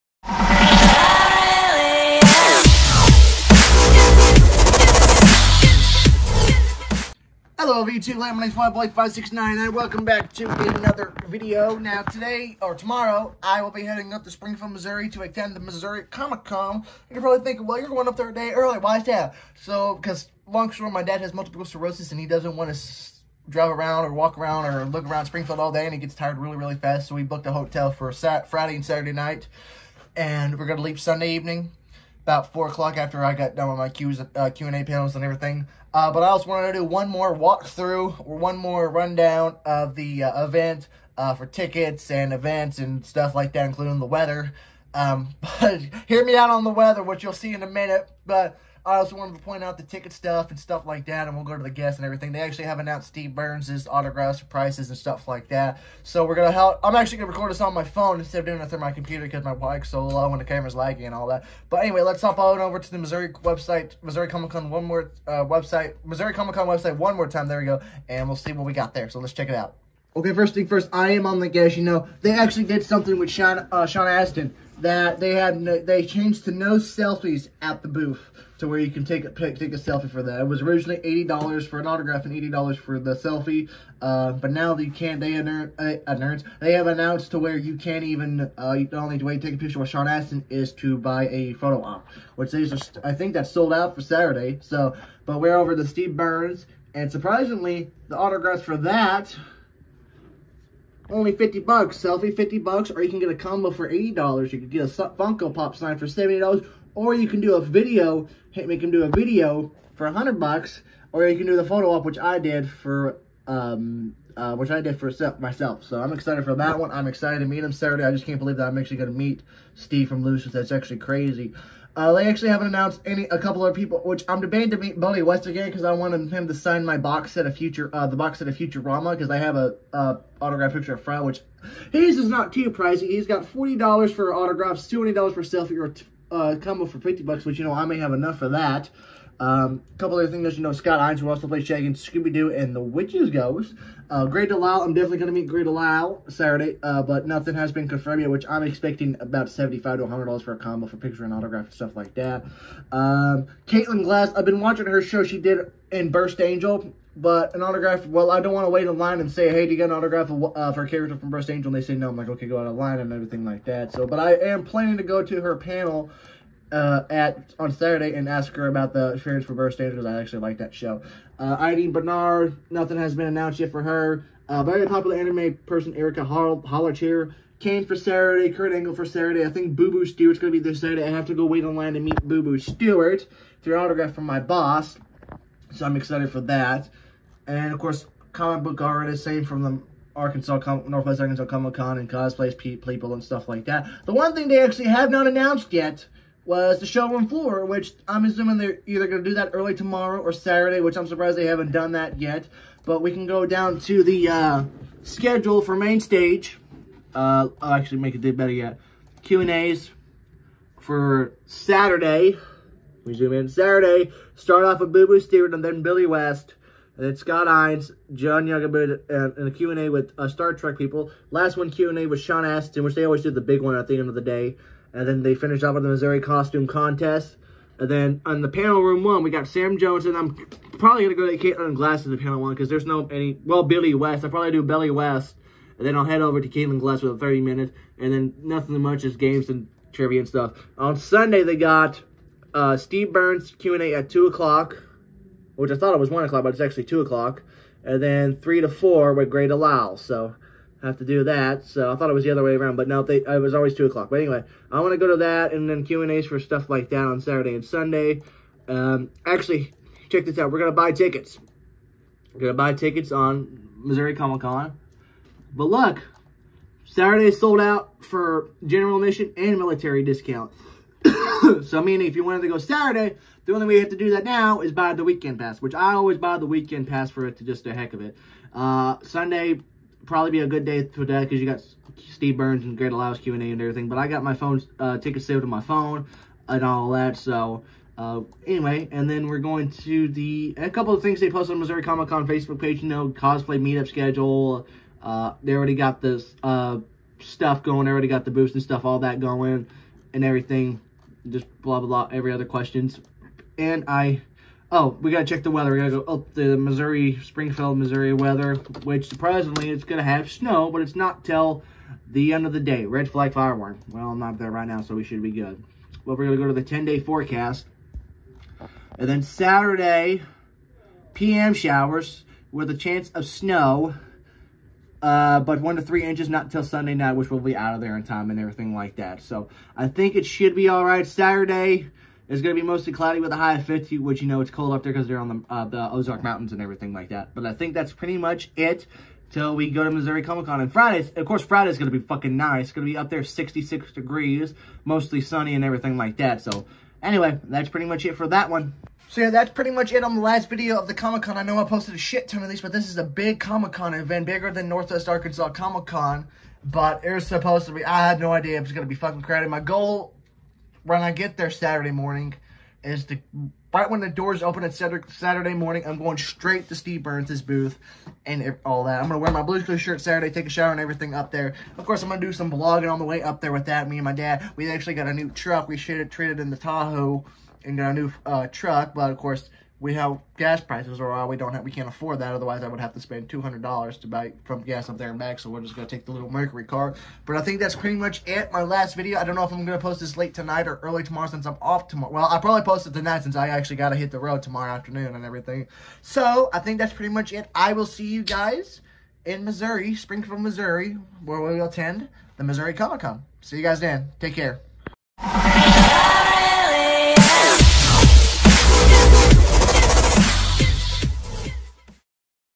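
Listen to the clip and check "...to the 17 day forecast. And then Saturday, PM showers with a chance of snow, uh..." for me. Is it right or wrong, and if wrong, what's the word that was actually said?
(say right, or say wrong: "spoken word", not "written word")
wrong: "10", not "17".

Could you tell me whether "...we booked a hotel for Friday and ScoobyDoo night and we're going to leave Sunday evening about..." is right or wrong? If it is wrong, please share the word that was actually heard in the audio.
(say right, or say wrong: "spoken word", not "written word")
wrong: "Saturday", not "ScoobyDoo".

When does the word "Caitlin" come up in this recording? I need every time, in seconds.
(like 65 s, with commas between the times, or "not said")
153 s, 231 s, 236 s.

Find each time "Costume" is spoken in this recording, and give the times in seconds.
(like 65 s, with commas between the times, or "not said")
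226 s.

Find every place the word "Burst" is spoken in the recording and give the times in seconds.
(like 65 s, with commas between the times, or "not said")
156 s, 161 s.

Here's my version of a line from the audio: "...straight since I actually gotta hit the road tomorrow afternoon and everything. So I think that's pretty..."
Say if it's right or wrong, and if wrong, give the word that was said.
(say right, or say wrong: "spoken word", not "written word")
wrong: "tonight", not "straight".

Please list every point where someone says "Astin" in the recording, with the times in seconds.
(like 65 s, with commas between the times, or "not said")
74 s, 90 s, 222 s.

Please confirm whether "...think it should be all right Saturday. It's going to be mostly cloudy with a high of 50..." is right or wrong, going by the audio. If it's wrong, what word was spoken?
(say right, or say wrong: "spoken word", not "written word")
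right.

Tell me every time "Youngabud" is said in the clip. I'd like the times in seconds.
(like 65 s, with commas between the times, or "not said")
218 s.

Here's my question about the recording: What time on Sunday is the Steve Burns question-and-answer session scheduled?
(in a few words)
2 o'clock.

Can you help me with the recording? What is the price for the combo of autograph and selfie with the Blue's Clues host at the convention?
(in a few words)
$80.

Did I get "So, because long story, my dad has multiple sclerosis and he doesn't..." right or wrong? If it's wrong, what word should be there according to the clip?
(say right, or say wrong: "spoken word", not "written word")
right.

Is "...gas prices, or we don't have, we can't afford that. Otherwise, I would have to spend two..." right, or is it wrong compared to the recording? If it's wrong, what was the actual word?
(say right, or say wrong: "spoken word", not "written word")
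right.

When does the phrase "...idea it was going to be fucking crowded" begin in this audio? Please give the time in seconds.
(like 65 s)
358 s.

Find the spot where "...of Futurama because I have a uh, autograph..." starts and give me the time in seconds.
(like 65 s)
128 s.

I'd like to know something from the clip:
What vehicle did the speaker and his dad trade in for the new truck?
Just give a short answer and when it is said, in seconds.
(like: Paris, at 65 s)
Tahoe, at 376 s.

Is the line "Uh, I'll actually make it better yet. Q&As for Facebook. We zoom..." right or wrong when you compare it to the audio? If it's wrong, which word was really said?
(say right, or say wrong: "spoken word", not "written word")
wrong: "Saturday", not "Facebook".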